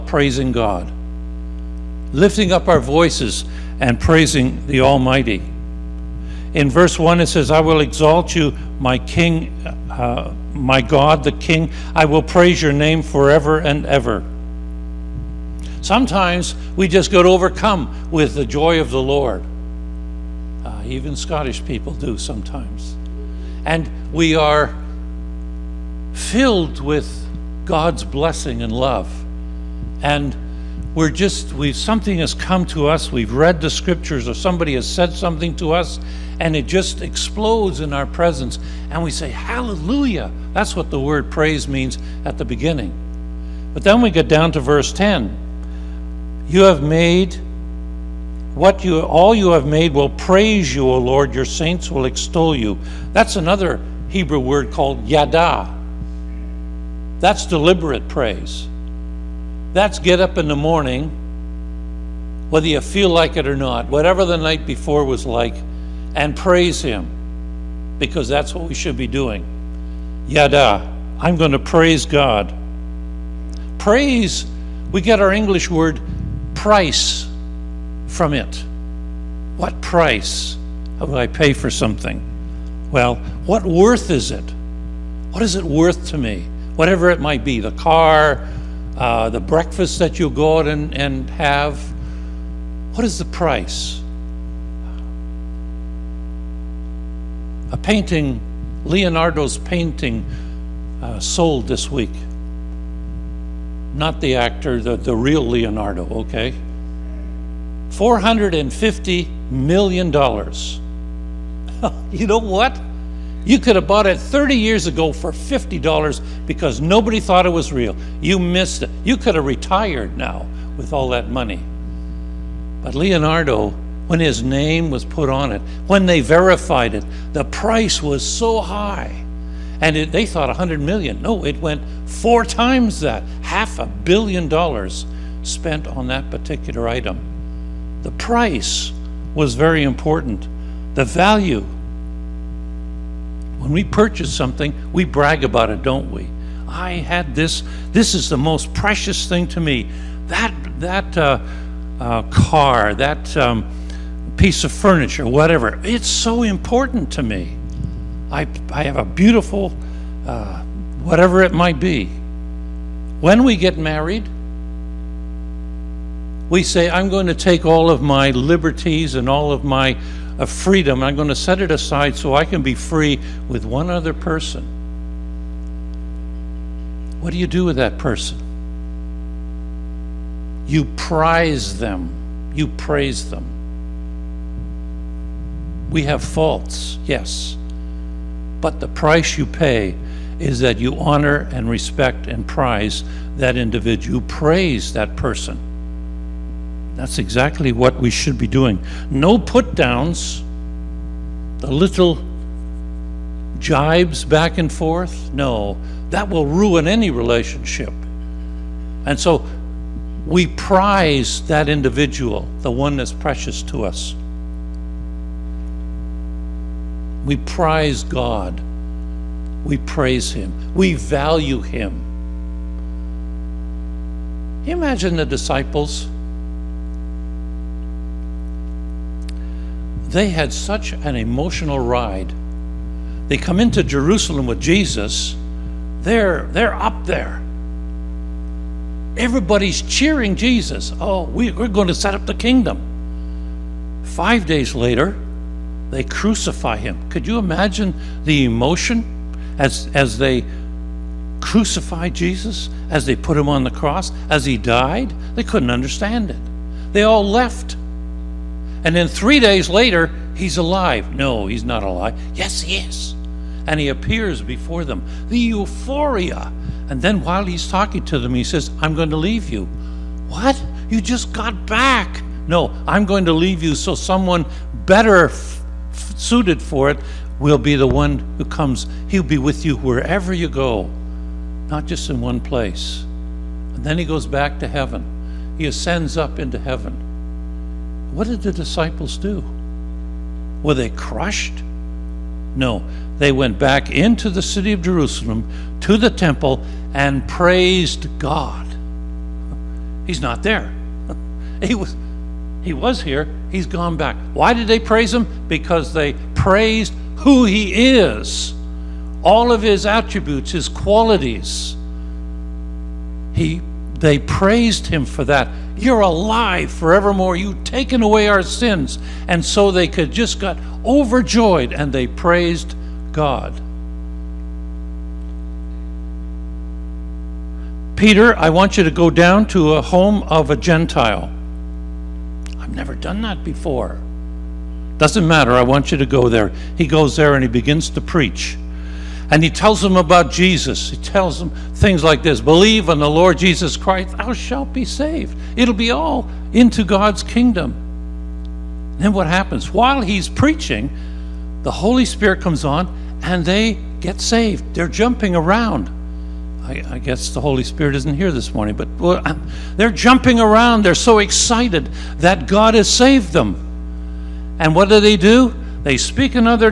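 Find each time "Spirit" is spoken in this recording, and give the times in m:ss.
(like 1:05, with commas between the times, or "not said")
5:52, 5:57.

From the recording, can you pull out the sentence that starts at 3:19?
No put downs, the little jibes back and forth.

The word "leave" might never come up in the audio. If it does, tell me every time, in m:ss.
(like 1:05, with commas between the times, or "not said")
4:29, 4:33.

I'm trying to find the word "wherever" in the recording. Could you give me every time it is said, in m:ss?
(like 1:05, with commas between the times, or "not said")
4:39.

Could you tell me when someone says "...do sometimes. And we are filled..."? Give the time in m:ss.
0:21.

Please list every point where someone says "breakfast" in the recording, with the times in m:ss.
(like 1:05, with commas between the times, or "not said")
1:29.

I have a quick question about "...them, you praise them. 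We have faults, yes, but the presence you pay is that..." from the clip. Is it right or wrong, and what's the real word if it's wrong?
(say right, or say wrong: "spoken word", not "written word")
wrong: "price", not "presence".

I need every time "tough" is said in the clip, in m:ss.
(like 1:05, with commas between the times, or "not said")
not said.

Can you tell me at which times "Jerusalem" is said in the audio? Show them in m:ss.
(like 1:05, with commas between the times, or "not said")
3:53, 4:54.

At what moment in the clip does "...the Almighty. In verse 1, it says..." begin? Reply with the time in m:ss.
0:04.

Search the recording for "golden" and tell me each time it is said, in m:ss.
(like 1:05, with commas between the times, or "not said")
not said.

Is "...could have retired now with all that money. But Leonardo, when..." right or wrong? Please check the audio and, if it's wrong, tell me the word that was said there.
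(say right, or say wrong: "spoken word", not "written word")
right.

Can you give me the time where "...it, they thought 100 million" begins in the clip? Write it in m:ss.
2:09.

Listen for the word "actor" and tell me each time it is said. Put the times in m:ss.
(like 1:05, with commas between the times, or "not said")
1:44.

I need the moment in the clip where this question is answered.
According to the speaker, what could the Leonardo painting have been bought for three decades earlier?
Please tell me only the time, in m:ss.
1:55.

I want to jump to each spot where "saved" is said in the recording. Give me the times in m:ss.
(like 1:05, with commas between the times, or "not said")
5:44, 5:54, 6:02.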